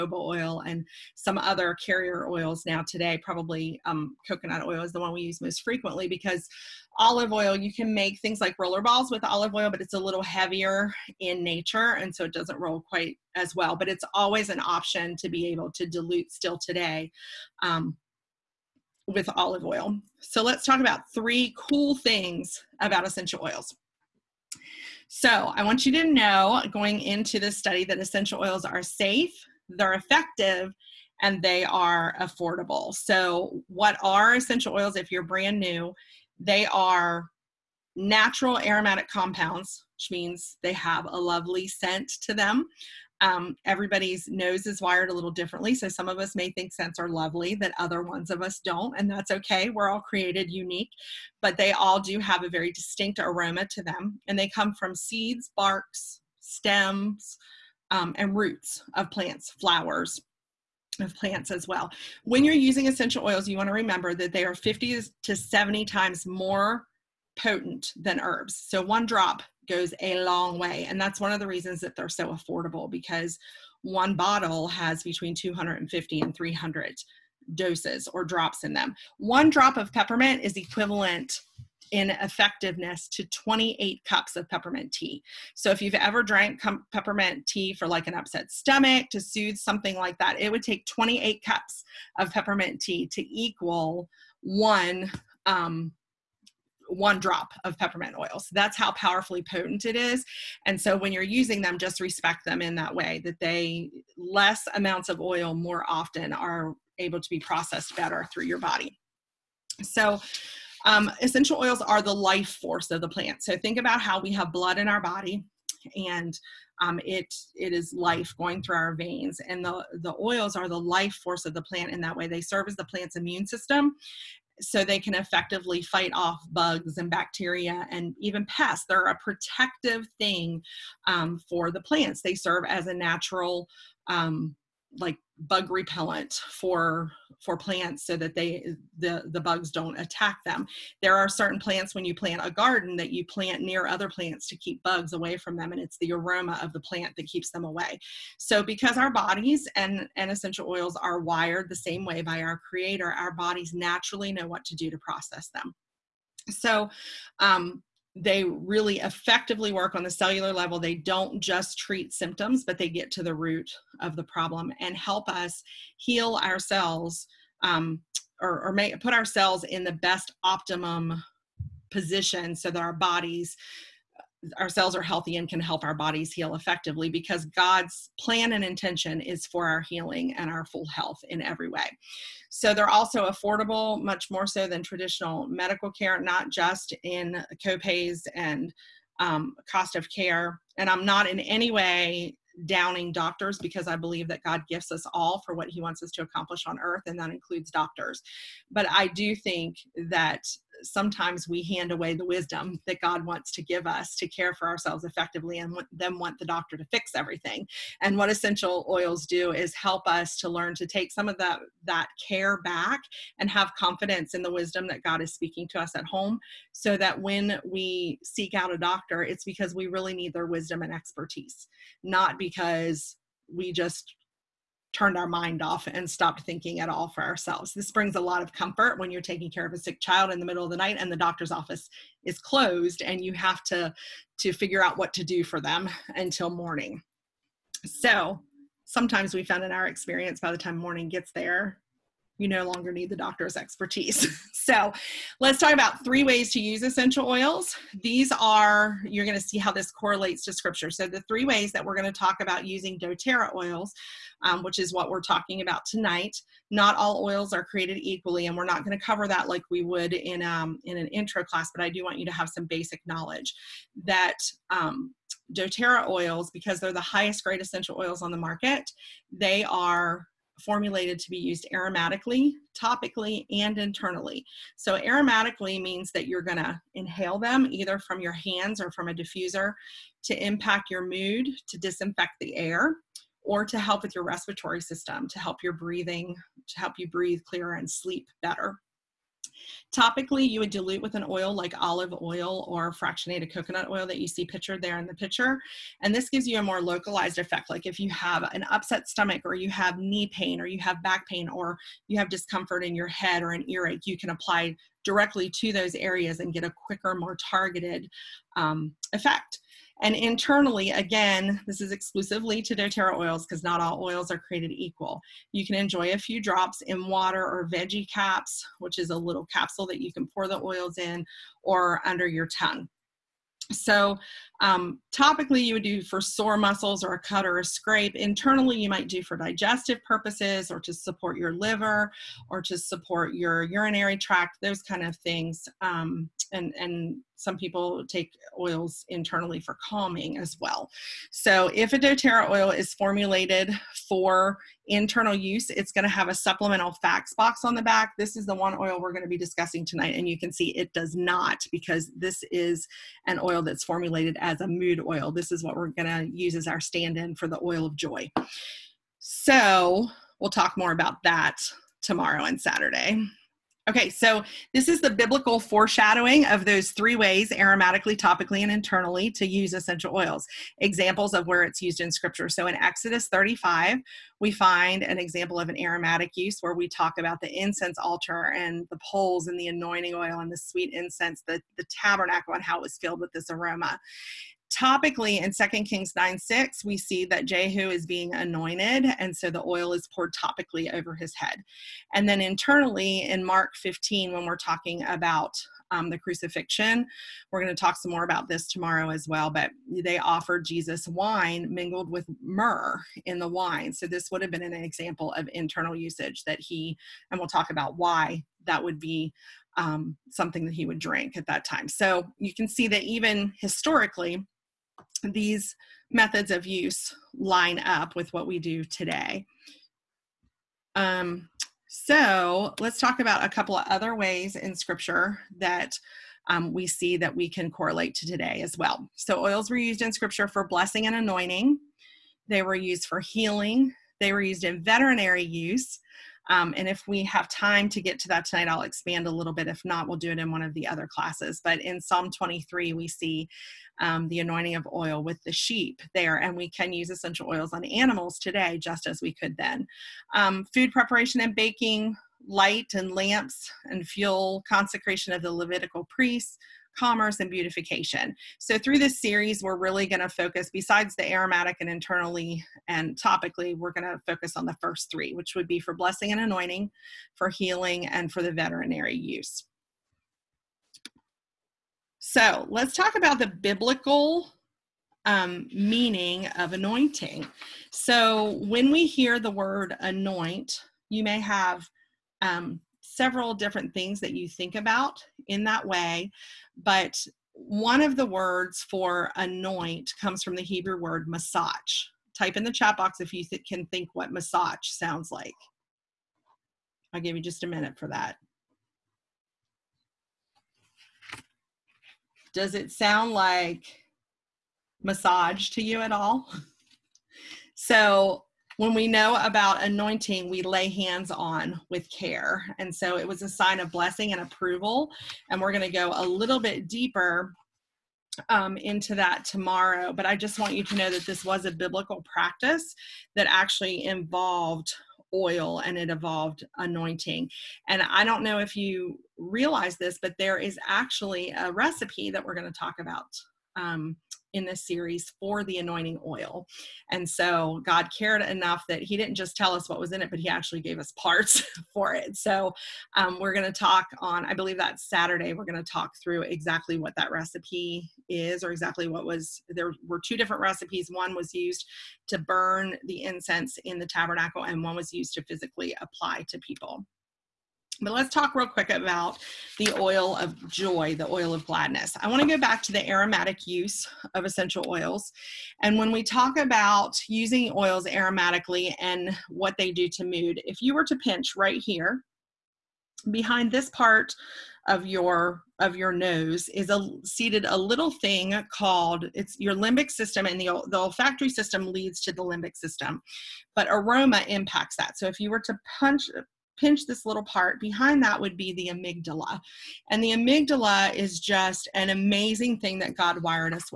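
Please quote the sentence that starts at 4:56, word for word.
And this gives you a more localized effect.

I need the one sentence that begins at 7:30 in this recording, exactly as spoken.
Um, food preparation and baking, light and lamps and fuel, consecration of the Levitical priests, commerce, and beautification.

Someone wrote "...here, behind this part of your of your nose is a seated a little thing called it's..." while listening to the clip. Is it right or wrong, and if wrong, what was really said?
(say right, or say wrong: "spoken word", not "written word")
right.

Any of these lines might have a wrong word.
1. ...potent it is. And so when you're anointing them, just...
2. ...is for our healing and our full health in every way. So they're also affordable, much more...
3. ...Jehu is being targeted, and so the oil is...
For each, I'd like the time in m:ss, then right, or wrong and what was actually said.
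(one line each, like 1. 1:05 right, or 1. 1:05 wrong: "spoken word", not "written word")
1. 1:39 wrong: "using", not "anointing"
2. 2:59 right
3. 6:27 wrong: "anointed", not "targeted".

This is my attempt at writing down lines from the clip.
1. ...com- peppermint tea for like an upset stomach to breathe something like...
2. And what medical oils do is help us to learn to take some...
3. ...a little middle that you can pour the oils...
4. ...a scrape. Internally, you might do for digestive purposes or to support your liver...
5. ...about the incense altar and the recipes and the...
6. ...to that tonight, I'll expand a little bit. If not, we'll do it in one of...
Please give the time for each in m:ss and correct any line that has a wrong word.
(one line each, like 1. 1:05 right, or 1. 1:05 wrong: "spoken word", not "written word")
1. 1:26 wrong: "soothe", not "breathe"
2. 3:28 wrong: "essential", not "medical"
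3. 5:19 wrong: "capsule", not "middle"
4. 5:27 right
5. 6:17 wrong: "poles", not "recipes"
6. 7:18 right.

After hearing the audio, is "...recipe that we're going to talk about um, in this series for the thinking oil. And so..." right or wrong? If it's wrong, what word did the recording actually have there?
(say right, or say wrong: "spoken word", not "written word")
wrong: "anointing", not "thinking".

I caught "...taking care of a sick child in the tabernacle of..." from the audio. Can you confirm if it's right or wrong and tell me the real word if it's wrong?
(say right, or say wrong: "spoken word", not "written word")
wrong: "middle", not "tabernacle".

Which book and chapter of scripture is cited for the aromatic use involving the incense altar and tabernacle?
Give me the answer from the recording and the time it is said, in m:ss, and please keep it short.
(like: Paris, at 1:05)
Exodus 35, at 6:12.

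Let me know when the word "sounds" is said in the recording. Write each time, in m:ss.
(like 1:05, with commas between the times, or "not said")
8:14, 8:22.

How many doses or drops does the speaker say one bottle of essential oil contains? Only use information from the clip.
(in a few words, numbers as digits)
250 to 300.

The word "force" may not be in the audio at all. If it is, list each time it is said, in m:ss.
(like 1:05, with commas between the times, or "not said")
1:52, 2:01.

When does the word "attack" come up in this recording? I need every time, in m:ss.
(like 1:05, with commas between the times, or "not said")
2:19.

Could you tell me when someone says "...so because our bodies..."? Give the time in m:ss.
2:28.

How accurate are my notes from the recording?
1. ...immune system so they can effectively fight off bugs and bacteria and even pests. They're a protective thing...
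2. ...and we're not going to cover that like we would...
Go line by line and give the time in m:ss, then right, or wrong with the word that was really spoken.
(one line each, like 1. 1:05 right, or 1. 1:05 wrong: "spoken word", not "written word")
1. 2:03 right
2. 4:18 right.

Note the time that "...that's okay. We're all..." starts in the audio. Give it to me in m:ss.
0:49.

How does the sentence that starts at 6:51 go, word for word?
So you can see that even historically, these methods of use line up with what we do today.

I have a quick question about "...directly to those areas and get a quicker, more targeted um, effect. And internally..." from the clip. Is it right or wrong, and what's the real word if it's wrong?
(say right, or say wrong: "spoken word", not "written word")
right.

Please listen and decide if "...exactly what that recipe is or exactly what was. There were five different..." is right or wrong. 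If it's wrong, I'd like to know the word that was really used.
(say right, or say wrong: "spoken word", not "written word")
wrong: "two", not "five".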